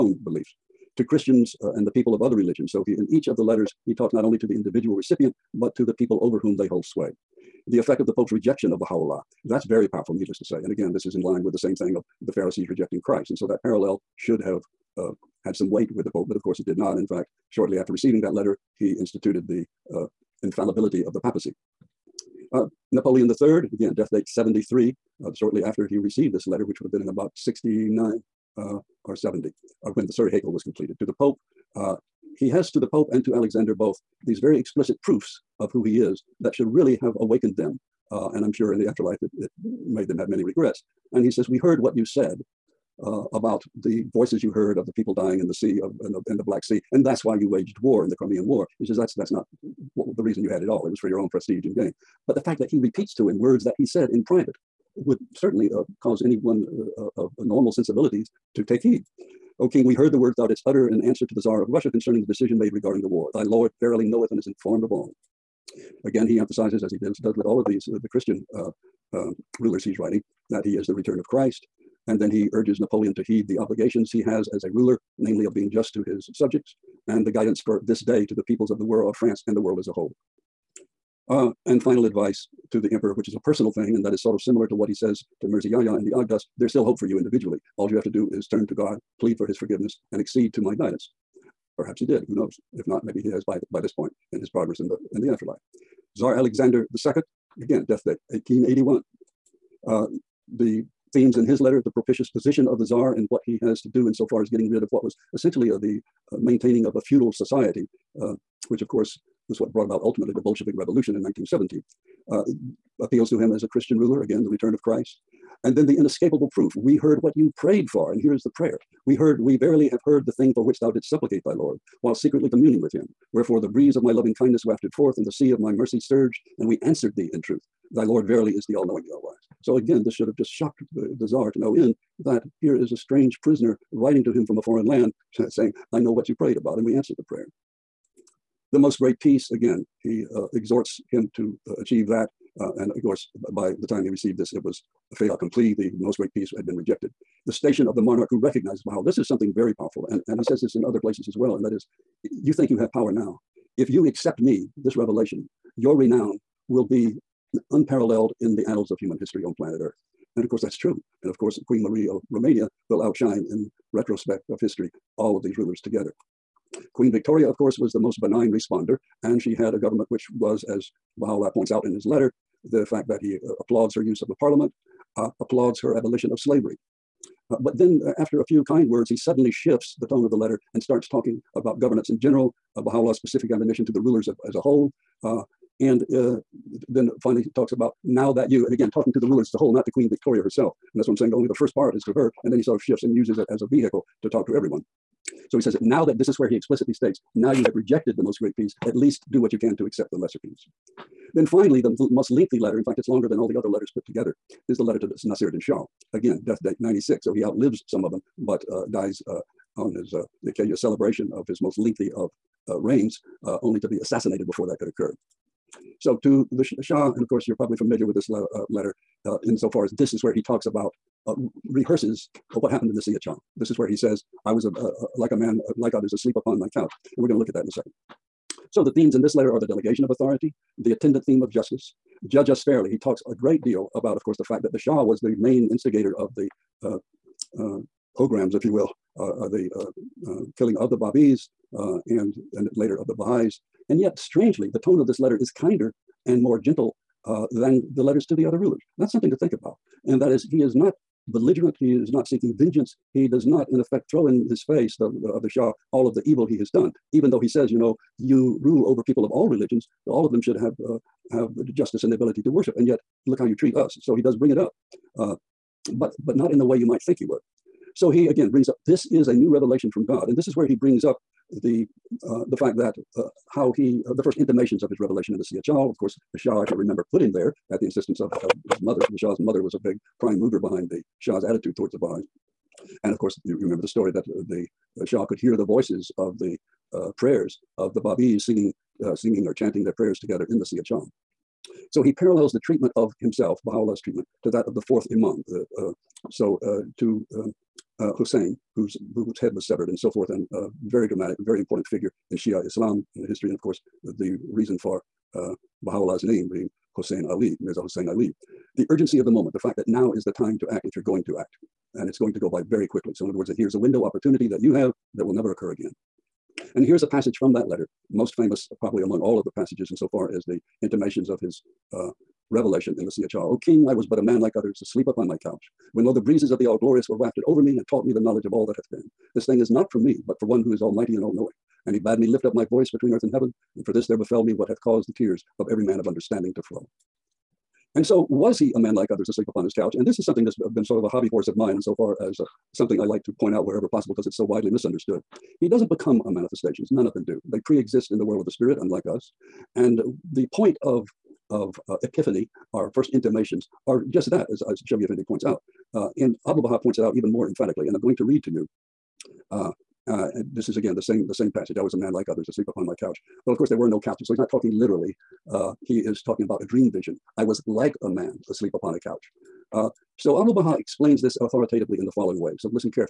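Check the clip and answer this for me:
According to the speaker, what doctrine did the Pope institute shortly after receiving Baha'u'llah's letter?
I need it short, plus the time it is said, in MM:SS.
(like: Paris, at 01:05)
Infallibility of the papacy, at 00:20.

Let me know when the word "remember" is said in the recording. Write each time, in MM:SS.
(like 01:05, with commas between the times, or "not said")
04:36, 04:43.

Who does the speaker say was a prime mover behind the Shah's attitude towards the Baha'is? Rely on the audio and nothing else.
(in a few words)
The Shah's mother.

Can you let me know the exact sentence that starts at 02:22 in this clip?
Uh, and of course, by the time he received this, it was a fait accompli.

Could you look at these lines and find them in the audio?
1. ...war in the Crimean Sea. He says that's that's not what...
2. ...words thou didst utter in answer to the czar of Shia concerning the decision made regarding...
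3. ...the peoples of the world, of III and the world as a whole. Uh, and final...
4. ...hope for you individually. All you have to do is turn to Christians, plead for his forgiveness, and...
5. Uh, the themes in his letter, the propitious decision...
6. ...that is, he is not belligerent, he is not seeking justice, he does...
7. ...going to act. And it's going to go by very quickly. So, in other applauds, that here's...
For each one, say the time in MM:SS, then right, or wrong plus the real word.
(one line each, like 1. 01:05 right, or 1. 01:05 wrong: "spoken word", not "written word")
1. 00:47 wrong: "War", not "Sea"
2. 01:00 wrong: "Russia", not "Shia"
3. 01:18 wrong: "France", not "III"
4. 01:26 wrong: "God", not "Christians"
5. 01:39 wrong: "position", not "decision"
6. 04:10 wrong: "vengeance", not "justice"
7. 05:11 wrong: "words", not "applauds".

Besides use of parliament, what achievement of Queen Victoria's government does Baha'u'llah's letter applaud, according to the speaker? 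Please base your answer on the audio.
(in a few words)
Abolition of slavery.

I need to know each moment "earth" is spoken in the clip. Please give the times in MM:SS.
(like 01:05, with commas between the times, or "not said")
02:39, 05:33.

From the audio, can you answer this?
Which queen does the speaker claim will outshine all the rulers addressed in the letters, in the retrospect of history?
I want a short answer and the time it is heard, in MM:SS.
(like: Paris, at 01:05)
Queen Marie of Romania, at 02:41.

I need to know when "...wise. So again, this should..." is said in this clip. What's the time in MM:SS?
02:09.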